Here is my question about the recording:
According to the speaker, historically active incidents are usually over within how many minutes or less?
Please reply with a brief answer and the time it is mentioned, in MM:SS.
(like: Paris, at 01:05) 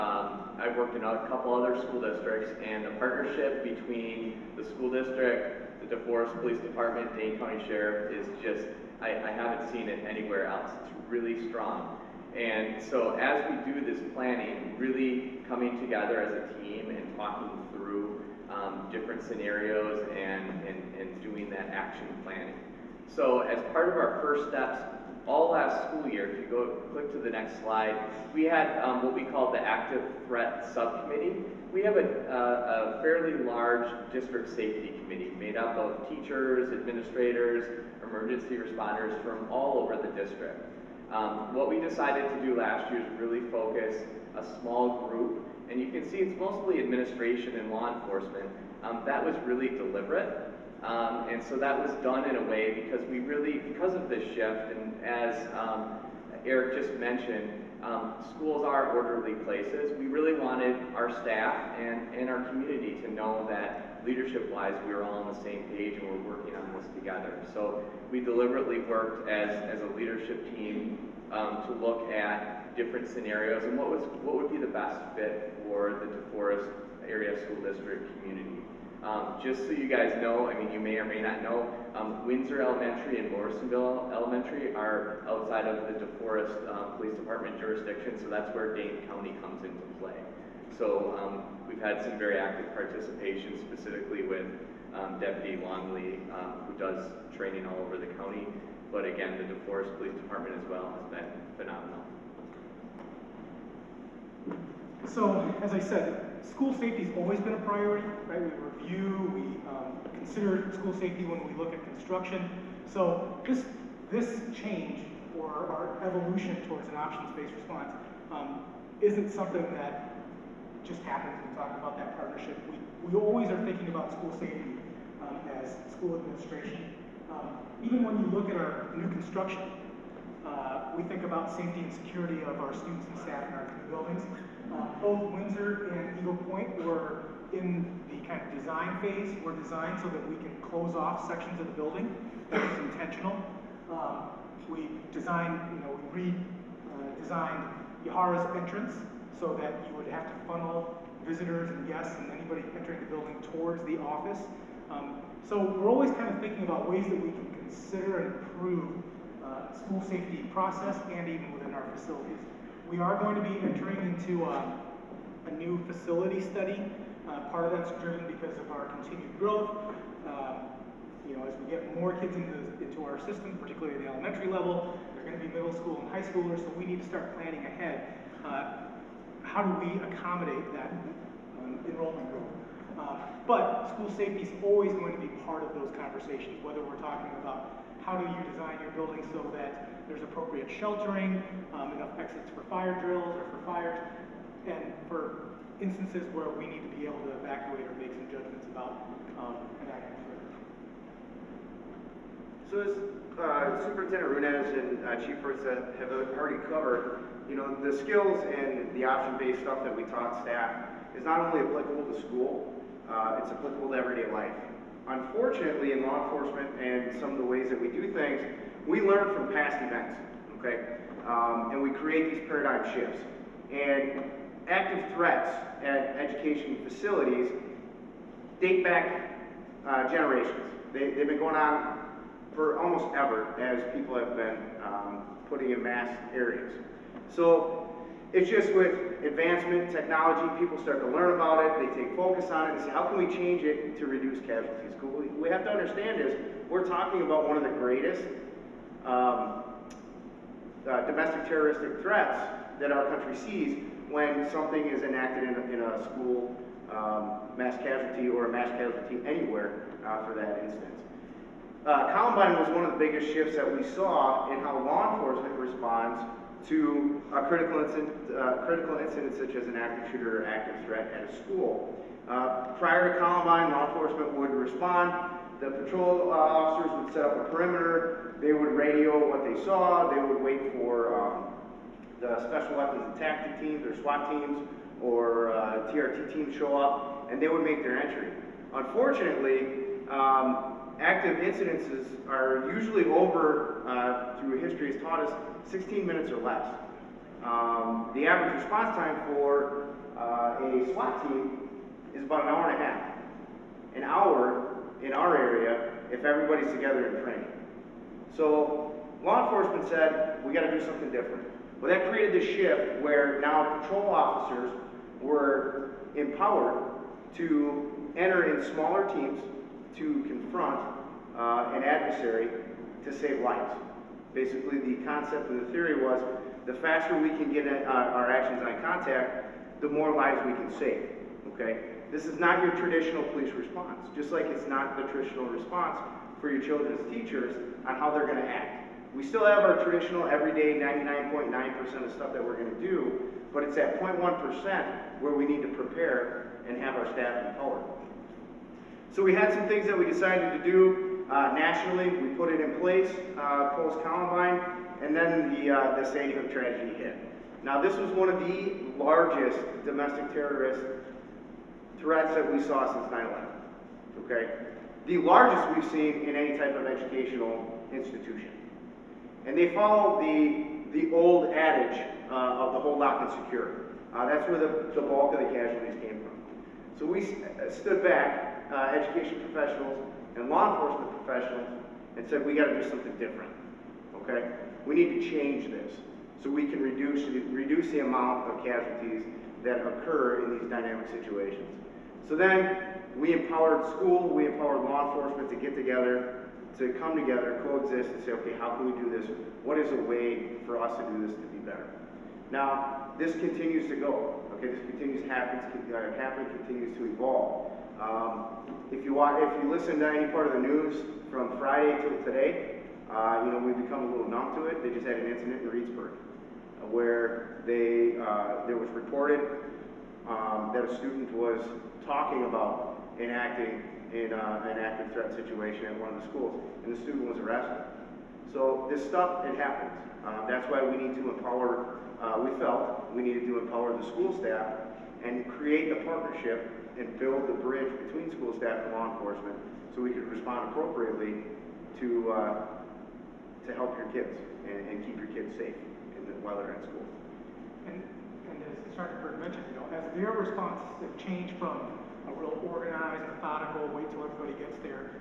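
16, at 04:55.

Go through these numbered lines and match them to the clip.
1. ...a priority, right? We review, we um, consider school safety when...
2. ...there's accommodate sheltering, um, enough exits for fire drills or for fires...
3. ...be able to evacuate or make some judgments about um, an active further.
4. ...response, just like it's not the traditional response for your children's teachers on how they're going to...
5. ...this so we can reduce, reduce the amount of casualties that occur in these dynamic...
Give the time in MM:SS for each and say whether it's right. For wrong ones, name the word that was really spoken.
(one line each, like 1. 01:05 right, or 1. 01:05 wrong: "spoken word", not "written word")
1. 01:47 right
2. 03:10 wrong: "appropriate", not "accommodate"
3. 03:16 right
4. 05:33 right
5. 06:25 right.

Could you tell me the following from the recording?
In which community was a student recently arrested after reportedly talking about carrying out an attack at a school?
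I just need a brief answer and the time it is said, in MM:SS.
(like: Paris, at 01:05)
Reedsburg, at 06:55.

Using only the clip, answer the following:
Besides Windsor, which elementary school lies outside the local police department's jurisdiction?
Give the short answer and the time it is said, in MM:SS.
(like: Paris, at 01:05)
Morrisonville Elementary, at 01:23.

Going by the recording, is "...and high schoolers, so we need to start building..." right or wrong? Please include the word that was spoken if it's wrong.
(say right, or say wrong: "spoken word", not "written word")
wrong: "planning", not "building".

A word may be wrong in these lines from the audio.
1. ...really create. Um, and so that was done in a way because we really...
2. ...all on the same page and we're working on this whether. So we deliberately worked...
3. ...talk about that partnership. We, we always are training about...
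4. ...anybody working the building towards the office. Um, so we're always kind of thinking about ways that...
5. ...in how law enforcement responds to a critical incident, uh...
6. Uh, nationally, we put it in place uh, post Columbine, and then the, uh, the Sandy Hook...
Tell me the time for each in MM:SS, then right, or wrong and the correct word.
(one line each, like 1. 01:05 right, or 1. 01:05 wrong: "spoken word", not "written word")
1. 00:49 wrong: "deliberate", not "create"
2. 01:05 wrong: "together", not "whether"
3. 02:01 wrong: "thinking", not "training"
4. 02:32 wrong: "entering", not "working"
5. 04:24 right
6. 05:51 right.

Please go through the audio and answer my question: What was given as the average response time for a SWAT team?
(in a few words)
an hour and a half.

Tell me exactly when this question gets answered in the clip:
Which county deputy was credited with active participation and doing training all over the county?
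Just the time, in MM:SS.
01:35.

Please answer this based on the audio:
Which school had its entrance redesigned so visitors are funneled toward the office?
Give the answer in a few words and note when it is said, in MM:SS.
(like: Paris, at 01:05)
Yahara, at 02:28.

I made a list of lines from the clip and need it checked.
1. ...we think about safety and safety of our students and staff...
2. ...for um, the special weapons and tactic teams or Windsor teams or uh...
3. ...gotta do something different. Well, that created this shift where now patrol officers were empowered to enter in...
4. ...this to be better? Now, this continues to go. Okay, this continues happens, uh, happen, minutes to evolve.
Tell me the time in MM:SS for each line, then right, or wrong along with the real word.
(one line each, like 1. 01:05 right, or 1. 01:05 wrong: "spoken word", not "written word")
1. 02:10 wrong: "security", not "safety"
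2. 04:40 wrong: "SWAT", not "Windsor"
3. 05:10 right
4. 06:41 wrong: "continues", not "minutes".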